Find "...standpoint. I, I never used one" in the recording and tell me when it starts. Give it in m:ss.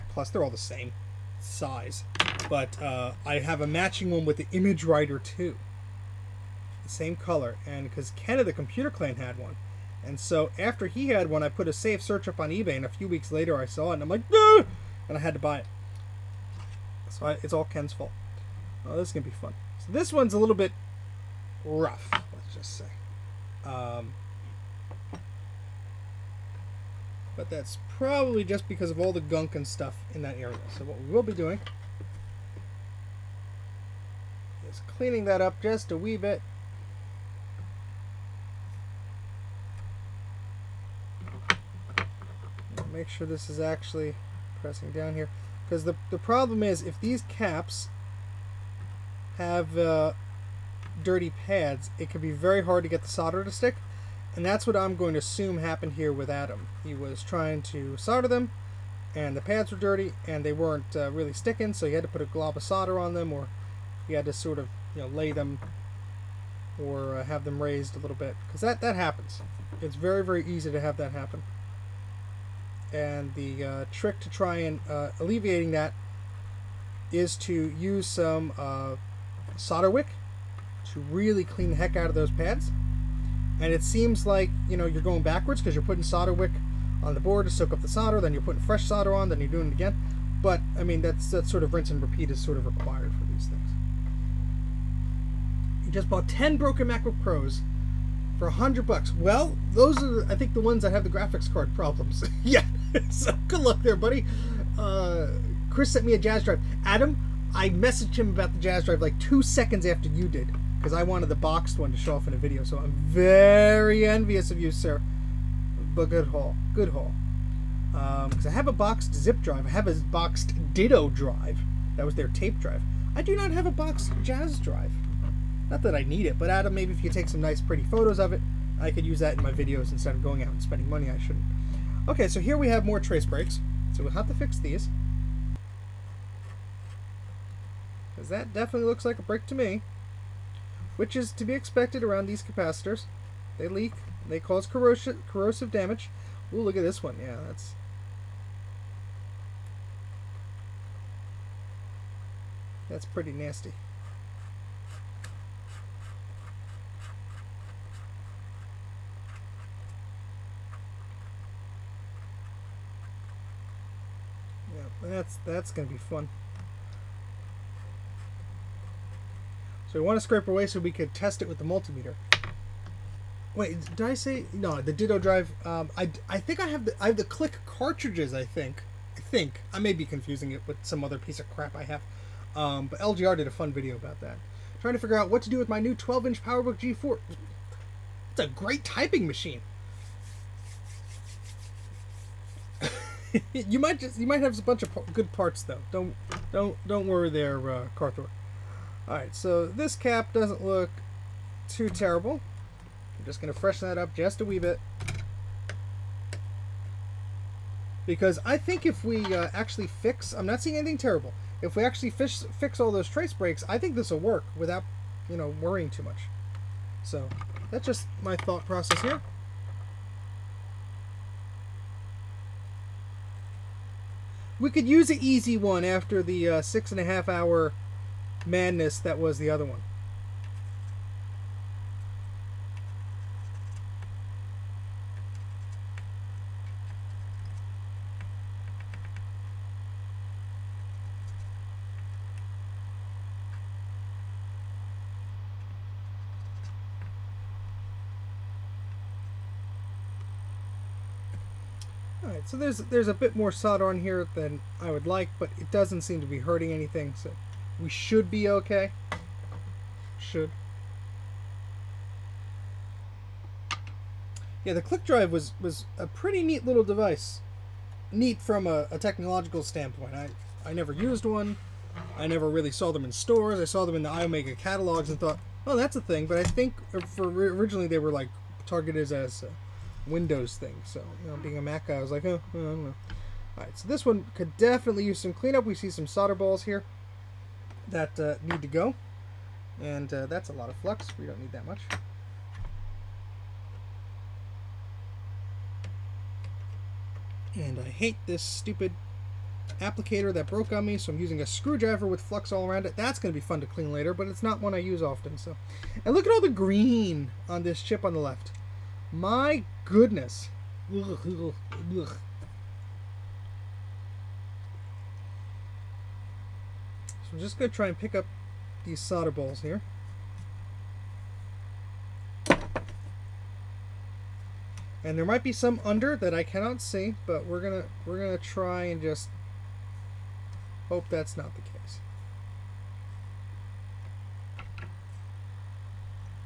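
4:29.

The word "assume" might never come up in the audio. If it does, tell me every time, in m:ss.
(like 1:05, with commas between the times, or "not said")
0:55.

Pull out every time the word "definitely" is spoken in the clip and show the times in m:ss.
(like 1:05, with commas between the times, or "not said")
2:18, 4:44.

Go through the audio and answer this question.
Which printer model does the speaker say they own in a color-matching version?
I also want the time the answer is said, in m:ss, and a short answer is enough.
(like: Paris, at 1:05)
ImageWriter 2, at 0:04.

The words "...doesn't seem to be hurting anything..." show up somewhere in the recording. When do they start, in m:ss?
4:15.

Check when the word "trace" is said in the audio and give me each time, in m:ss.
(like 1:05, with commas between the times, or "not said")
2:12, 3:33.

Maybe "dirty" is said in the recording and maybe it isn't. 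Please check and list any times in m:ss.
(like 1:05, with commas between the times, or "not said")
0:51, 0:59.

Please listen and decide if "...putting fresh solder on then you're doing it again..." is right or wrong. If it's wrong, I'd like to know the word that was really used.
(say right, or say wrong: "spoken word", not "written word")
right.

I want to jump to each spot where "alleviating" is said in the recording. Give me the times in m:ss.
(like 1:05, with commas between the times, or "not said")
1:15.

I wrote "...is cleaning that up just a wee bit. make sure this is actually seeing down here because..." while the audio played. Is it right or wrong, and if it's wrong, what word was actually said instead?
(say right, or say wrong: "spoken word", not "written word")
wrong: "pressing", not "seeing".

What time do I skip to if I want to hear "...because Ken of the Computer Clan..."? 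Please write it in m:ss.
0:07.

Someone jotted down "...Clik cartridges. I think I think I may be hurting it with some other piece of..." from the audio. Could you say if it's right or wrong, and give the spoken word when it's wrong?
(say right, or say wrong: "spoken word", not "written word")
wrong: "confusing", not "hurting".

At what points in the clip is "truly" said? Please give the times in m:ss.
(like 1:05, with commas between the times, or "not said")
not said.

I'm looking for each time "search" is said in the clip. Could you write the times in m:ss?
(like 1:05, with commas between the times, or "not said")
0:12.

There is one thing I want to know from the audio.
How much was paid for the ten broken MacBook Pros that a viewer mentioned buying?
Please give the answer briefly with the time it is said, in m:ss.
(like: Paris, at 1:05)
$100, at 1:38.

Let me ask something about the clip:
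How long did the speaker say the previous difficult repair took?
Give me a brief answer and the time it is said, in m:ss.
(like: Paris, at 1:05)
6.5 hours, at 3:46.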